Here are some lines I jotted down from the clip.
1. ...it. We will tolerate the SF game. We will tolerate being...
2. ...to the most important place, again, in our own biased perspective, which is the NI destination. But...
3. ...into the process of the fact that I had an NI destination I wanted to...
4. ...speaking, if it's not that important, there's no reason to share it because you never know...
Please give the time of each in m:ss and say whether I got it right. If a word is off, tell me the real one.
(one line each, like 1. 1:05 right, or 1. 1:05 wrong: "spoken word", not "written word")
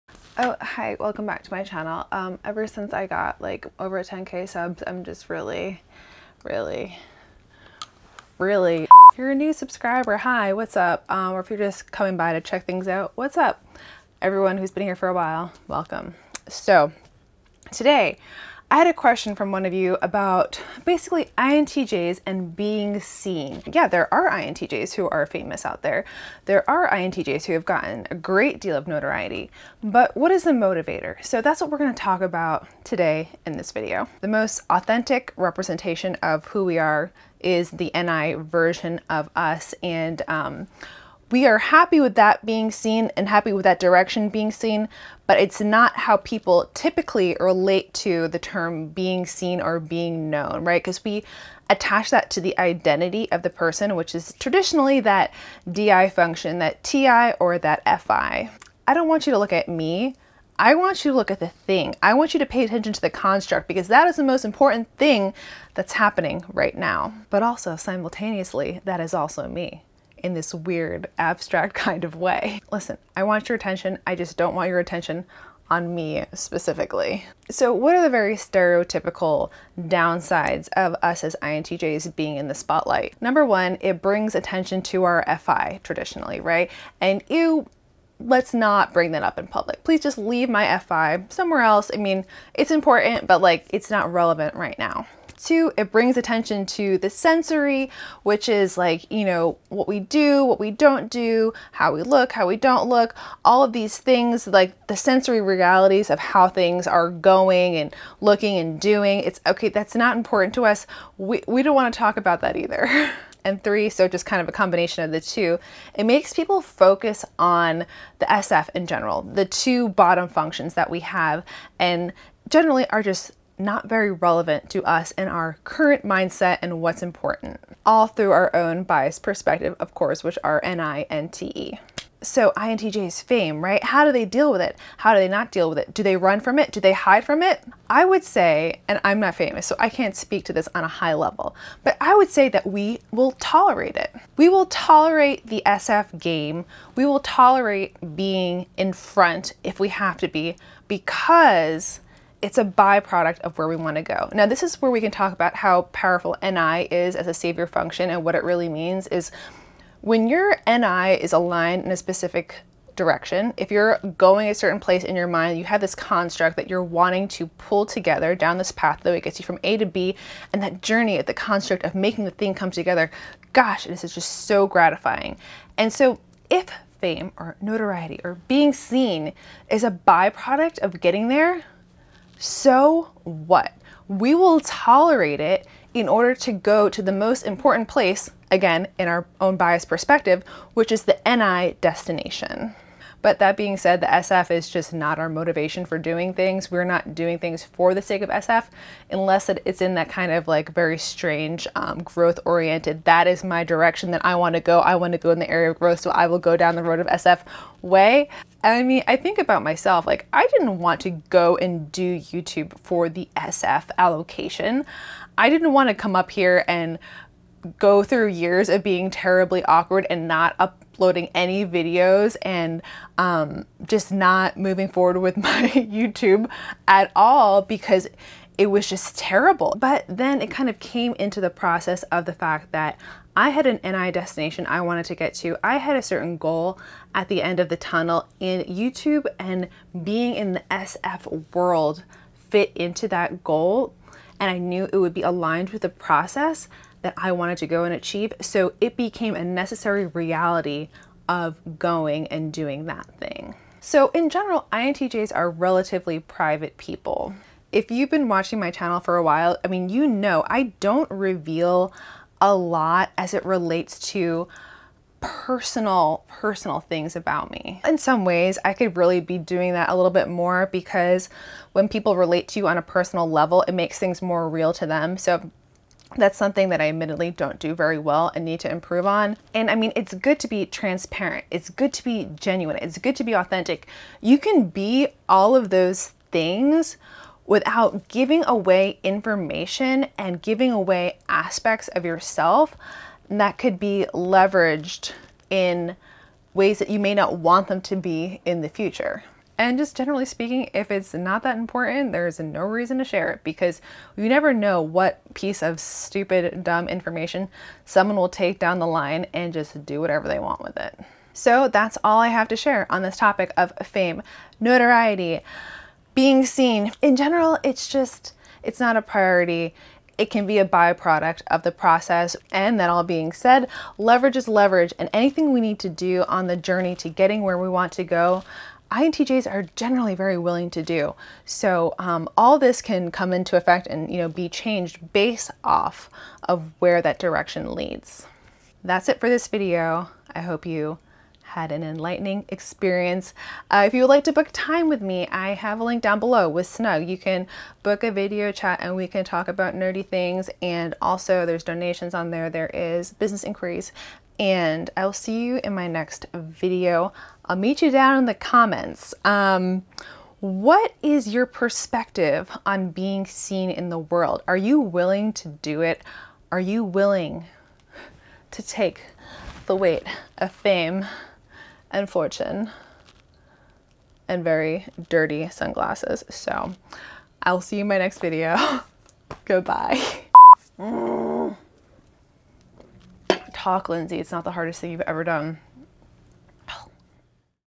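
1. 2:23 right
2. 3:06 right
3. 3:51 right
4. 5:00 right.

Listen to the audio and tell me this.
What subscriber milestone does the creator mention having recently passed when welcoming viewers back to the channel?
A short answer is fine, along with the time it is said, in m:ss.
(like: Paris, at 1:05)
10k, at 0:04.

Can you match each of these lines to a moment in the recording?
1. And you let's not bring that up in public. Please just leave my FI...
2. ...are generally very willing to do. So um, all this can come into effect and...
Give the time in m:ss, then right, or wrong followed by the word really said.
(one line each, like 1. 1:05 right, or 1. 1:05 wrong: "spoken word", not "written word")
1. 1:26 right
2. 5:29 right.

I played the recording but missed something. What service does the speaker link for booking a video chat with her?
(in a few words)
Snugg.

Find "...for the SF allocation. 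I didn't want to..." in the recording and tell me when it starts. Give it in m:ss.
3:32.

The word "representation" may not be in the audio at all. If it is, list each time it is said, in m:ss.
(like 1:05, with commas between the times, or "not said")
0:35.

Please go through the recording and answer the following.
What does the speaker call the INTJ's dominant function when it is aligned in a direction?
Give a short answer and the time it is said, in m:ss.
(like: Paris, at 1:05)
savior function, at 2:37.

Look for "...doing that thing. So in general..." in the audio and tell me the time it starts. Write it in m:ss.
4:12.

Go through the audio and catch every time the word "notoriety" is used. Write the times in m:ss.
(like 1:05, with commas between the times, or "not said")
0:28, 2:57, 5:14.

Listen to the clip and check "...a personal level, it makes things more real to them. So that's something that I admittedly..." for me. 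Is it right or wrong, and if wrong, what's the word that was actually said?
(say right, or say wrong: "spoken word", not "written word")
right.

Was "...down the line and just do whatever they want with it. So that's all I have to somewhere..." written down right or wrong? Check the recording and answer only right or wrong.
wrong.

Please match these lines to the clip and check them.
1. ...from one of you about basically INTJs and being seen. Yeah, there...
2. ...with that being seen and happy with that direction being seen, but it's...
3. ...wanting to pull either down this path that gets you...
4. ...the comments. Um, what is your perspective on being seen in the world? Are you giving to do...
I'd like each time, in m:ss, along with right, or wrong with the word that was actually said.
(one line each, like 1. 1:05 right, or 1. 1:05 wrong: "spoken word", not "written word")
1. 0:19 right
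2. 0:42 right
3. 2:46 wrong: "together", not "either"
4. 5:58 wrong: "willing", not "giving".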